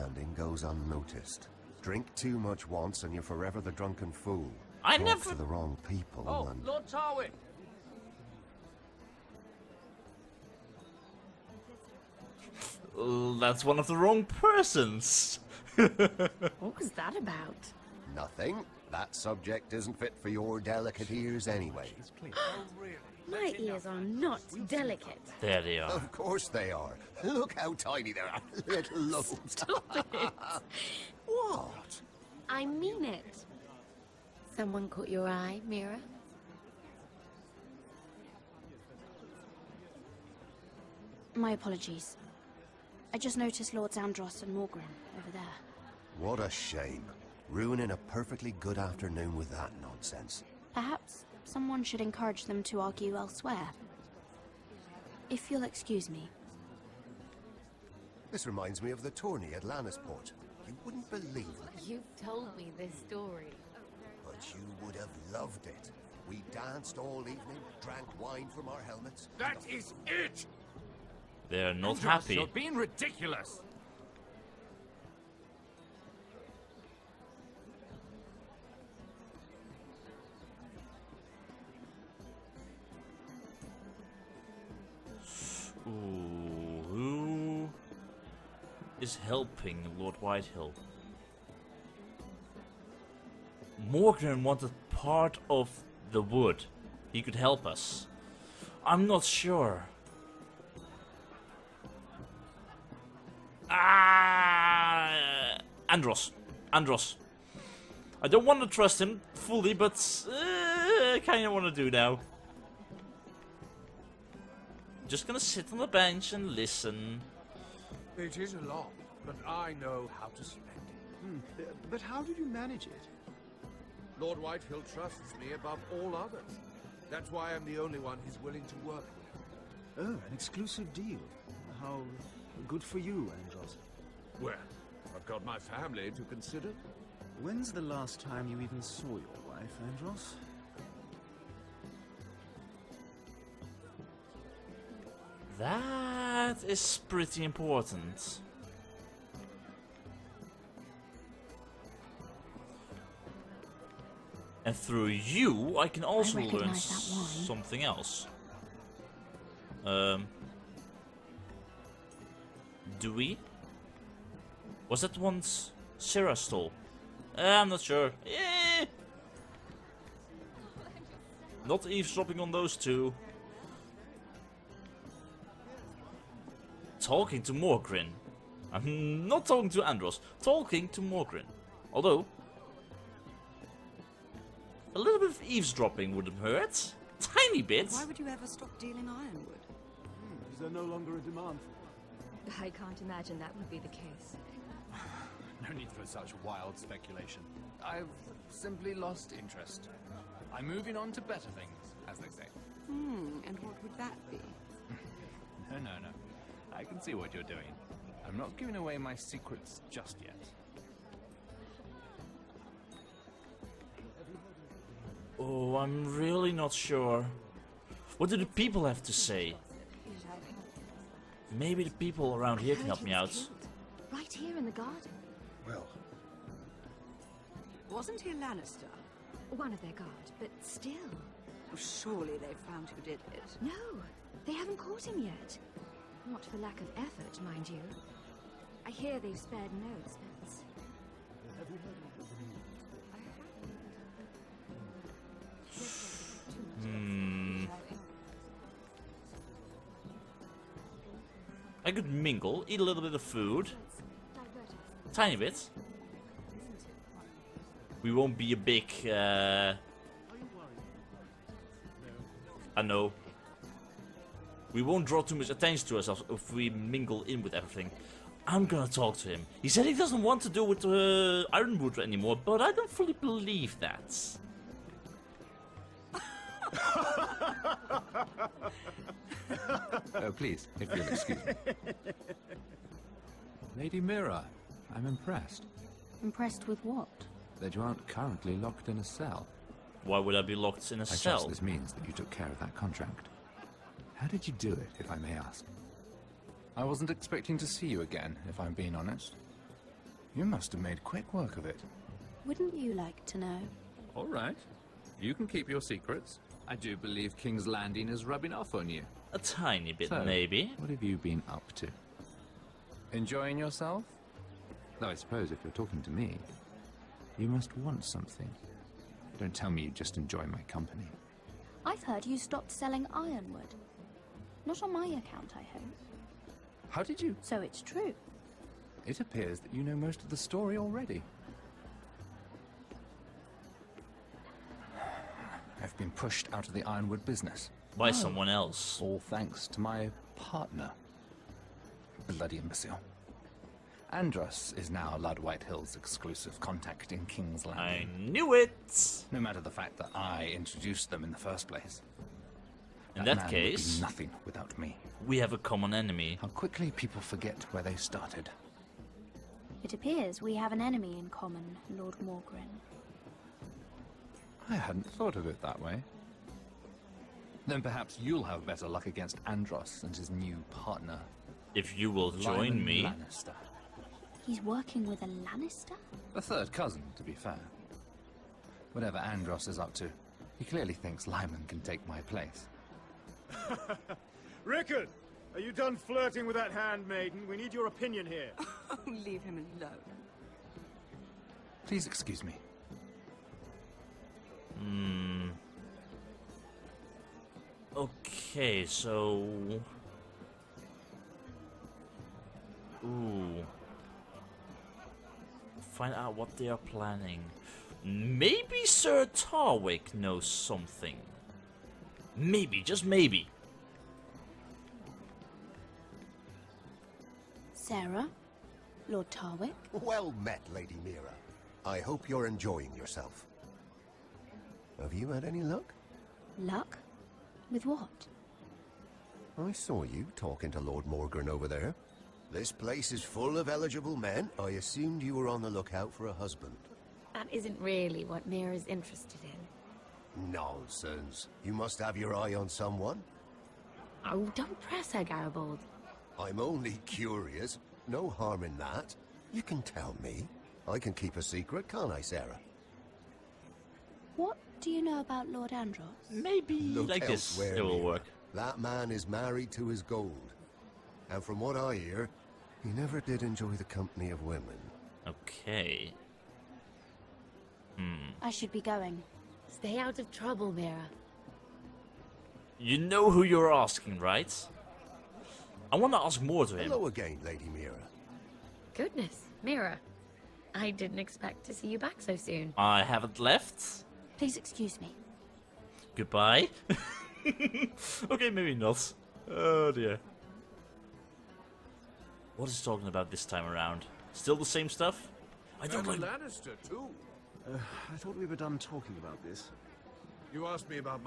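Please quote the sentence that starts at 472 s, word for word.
You know who you're asking, right?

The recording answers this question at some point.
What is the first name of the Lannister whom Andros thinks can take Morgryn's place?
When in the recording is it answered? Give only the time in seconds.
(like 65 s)
381 s.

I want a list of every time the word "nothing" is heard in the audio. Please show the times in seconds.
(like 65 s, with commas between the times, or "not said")
18 s, 353 s.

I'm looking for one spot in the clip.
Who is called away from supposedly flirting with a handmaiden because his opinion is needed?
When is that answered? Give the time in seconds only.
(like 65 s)
384 s.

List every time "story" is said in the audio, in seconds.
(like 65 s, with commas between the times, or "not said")
63 s, 330 s.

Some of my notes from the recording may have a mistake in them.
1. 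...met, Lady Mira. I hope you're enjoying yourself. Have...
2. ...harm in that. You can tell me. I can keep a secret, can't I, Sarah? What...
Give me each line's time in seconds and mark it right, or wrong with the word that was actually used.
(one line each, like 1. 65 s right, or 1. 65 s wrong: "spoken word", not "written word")
1. 420 s right
2. 448 s right.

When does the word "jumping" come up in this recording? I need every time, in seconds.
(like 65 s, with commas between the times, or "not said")
not said.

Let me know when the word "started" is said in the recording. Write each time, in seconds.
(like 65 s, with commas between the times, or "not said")
357 s.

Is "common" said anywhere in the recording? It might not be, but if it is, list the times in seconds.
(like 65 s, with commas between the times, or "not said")
355 s, 361 s.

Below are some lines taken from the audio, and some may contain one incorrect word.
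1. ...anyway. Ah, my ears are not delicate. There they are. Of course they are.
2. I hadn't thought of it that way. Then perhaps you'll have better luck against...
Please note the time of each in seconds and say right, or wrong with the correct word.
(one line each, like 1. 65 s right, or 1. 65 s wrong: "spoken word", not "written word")
1. 21 s right
2. 364 s right.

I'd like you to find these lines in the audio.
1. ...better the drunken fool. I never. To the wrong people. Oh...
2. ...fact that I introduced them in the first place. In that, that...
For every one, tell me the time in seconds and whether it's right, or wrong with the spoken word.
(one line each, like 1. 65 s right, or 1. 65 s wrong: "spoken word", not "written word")
1. 3 s wrong: "forever", not "better"
2. 349 s right.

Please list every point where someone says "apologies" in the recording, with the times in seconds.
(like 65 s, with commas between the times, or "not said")
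41 s.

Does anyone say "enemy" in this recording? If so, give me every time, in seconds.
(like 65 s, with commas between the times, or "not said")
355 s, 360 s.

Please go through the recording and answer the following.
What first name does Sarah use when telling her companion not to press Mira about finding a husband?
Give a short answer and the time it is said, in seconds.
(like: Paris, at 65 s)
Garibald, at 445 s.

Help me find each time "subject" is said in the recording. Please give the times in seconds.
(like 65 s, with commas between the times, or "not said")
19 s.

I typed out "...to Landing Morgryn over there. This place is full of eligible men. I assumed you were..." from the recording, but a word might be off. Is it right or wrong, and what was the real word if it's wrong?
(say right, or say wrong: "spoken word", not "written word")
wrong: "Lord", not "Landing".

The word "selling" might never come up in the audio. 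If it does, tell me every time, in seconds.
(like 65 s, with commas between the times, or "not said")
322 s.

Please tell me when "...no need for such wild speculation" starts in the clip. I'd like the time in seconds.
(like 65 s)
195 s.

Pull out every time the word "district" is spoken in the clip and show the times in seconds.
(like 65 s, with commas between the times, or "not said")
not said.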